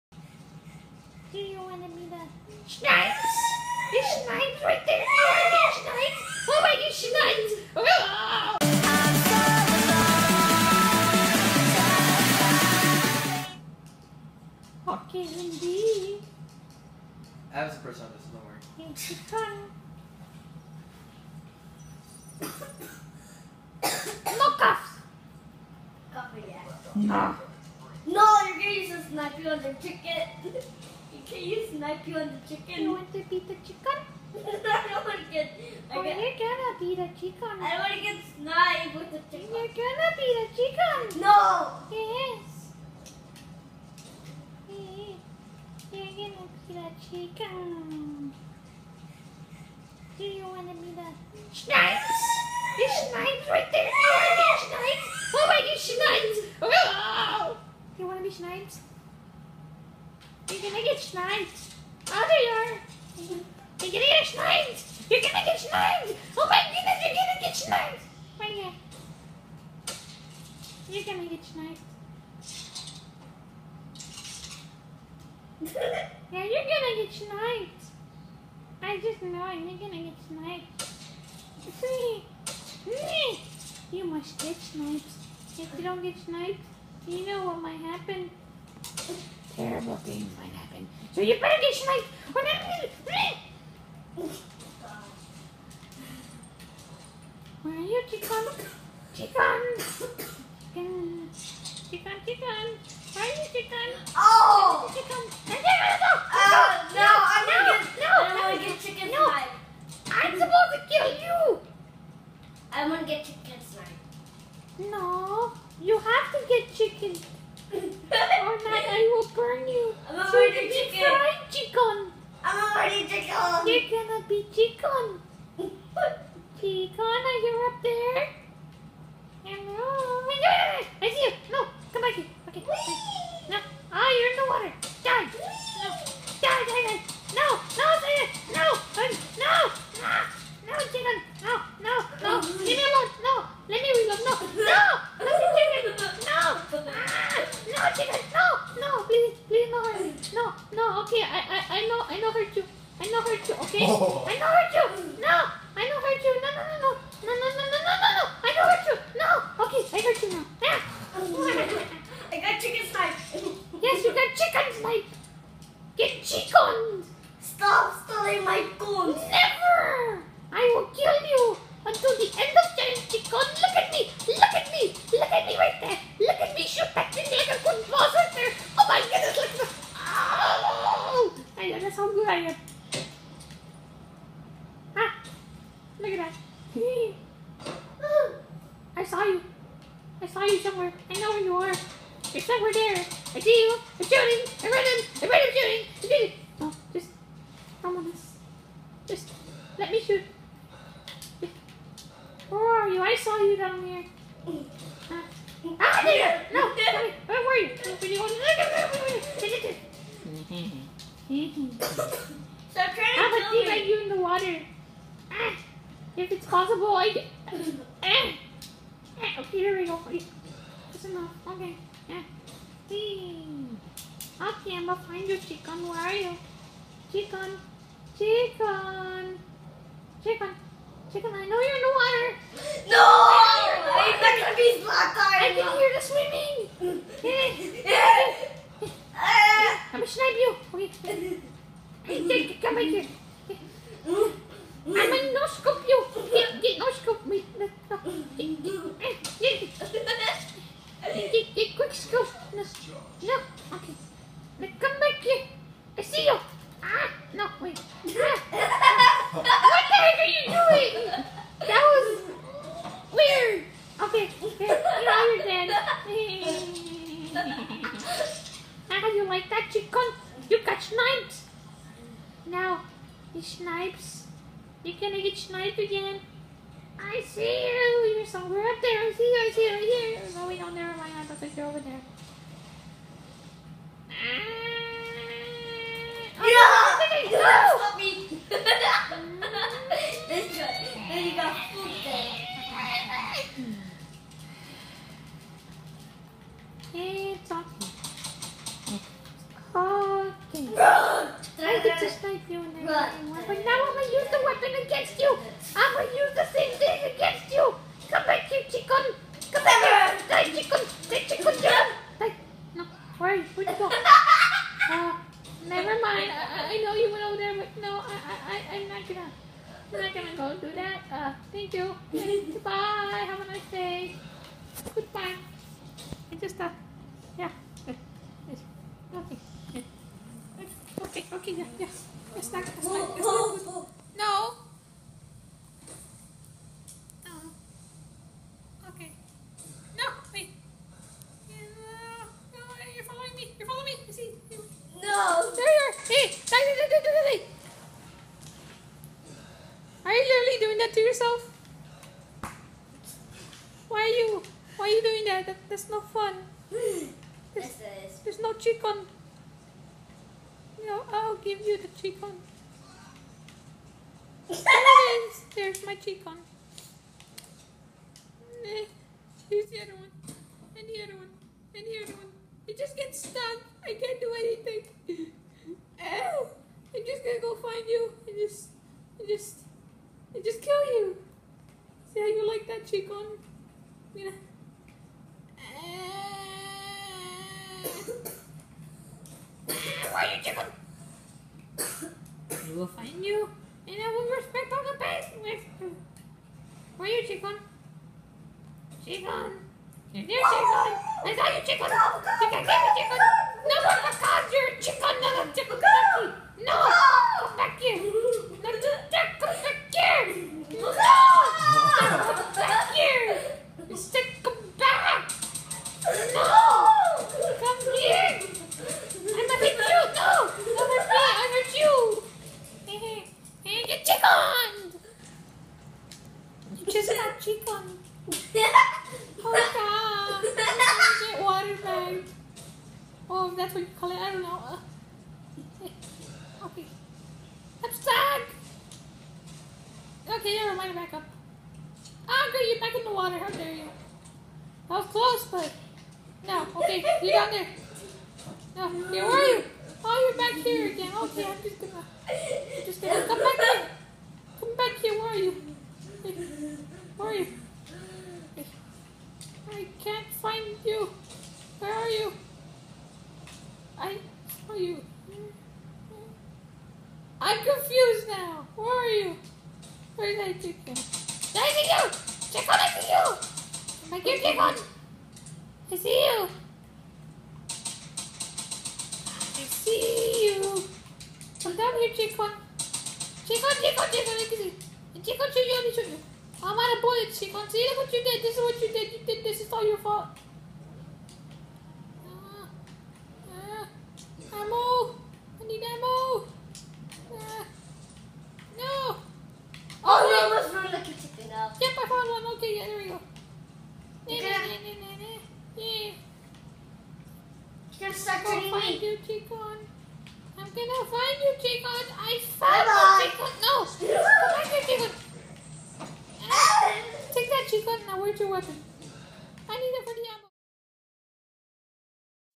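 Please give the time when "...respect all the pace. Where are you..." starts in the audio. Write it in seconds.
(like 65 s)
394 s.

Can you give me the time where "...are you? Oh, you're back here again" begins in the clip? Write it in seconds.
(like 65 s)
449 s.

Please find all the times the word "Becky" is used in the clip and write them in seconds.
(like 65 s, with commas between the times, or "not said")
407 s.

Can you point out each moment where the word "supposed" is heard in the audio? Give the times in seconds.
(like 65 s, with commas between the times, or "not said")
110 s.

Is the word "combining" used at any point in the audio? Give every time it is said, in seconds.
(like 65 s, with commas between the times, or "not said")
not said.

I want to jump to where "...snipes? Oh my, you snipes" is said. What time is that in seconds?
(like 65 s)
54 s.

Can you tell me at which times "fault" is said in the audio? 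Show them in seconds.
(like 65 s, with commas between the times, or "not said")
489 s.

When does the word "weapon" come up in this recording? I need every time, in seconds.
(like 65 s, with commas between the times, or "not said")
304 s, 518 s.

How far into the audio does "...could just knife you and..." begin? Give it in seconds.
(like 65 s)
301 s.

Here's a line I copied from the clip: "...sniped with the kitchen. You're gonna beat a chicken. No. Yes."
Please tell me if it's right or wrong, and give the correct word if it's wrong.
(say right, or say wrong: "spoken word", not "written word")
wrong: "chicken", not "kitchen".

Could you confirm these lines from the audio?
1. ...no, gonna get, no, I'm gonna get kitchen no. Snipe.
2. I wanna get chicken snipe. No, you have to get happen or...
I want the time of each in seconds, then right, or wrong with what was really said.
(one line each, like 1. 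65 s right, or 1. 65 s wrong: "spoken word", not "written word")
1. 107 s wrong: "chicken", not "kitchen"
2. 112 s wrong: "chicken", not "happen".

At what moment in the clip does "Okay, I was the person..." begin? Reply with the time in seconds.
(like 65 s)
14 s.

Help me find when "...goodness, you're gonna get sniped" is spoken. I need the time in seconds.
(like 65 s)
66 s.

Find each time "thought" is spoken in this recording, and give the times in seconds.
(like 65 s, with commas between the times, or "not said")
281 s.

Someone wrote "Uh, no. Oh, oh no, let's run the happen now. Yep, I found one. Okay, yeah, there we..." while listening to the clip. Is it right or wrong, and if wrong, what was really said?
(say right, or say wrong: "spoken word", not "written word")
wrong: "kitchen", not "happen".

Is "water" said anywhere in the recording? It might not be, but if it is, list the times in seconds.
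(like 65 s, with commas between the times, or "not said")
214 s, 231 s, 431 s, 443 s.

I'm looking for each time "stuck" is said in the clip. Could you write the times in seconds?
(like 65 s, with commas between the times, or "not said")
373 s, 437 s.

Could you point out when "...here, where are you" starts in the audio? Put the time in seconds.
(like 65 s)
455 s.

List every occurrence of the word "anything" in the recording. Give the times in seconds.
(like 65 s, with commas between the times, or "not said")
374 s.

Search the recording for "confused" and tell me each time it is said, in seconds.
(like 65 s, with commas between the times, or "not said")
467 s.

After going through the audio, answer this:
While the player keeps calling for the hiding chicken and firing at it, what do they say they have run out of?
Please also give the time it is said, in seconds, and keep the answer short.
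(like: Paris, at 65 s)
bullets, at 487 s.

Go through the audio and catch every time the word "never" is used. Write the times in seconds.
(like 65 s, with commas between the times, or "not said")
280 s, 315 s, 440 s.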